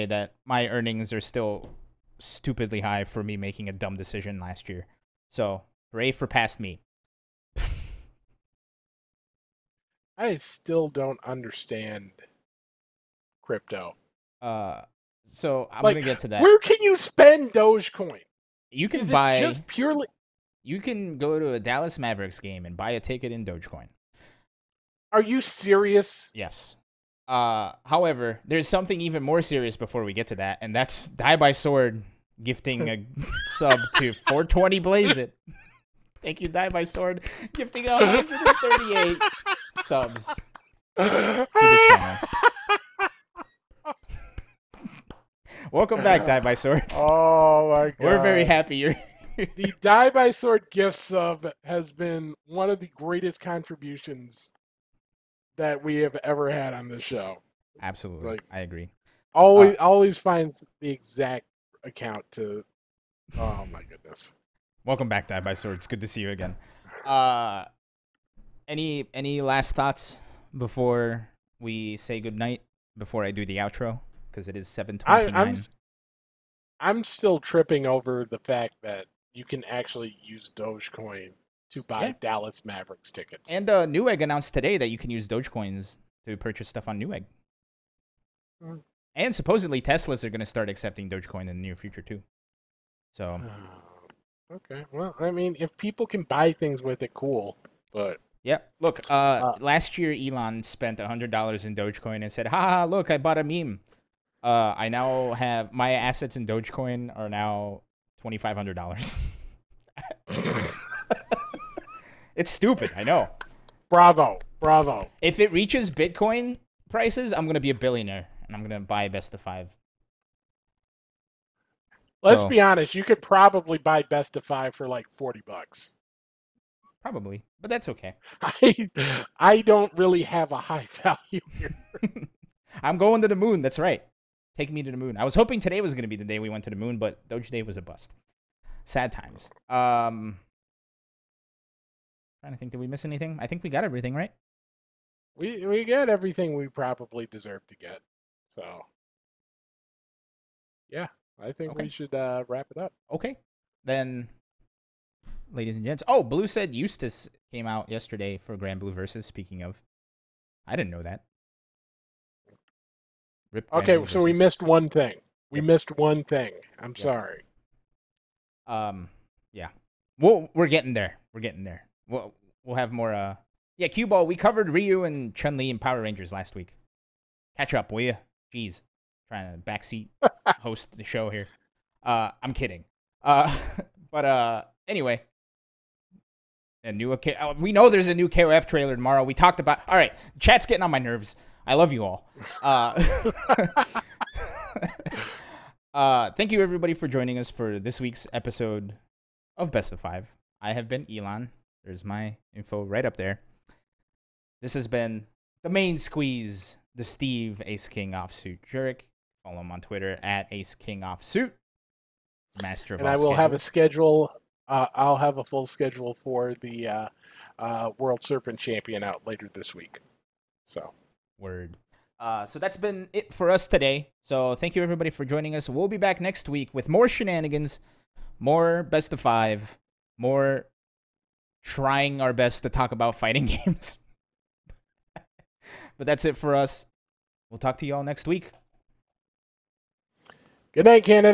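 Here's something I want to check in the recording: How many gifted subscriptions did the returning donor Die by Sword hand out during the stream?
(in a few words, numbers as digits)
138.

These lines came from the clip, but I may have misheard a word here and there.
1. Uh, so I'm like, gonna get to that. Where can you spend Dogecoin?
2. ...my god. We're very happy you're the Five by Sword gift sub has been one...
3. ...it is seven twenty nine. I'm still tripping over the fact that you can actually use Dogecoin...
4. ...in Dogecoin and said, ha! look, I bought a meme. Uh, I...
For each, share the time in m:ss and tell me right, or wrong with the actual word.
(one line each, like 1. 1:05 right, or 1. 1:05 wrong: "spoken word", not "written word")
1. 0:14 right
2. 0:47 wrong: "Die", not "Five"
3. 1:14 right
4. 1:41 right.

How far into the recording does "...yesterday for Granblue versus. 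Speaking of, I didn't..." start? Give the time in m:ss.
2:37.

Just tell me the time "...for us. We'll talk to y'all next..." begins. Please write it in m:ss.
3:56.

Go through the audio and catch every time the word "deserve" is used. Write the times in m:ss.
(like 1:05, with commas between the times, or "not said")
2:27.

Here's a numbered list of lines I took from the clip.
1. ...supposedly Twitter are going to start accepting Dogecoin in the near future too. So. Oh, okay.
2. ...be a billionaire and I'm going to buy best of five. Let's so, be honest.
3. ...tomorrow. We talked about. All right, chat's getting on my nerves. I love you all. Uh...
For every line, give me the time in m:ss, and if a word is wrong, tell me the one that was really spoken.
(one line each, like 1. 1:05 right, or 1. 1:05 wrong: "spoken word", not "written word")
1. 1:29 wrong: "Teslas", not "Twitter"
2. 1:57 right
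3. 3:08 right.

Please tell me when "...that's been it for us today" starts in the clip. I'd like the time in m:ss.
3:42.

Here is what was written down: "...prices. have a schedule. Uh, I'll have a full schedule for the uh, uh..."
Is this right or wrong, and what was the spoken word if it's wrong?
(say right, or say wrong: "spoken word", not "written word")
wrong: "schedules", not "prices".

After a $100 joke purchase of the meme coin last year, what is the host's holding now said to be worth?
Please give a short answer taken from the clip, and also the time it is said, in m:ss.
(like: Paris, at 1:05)
$2,500, at 1:48.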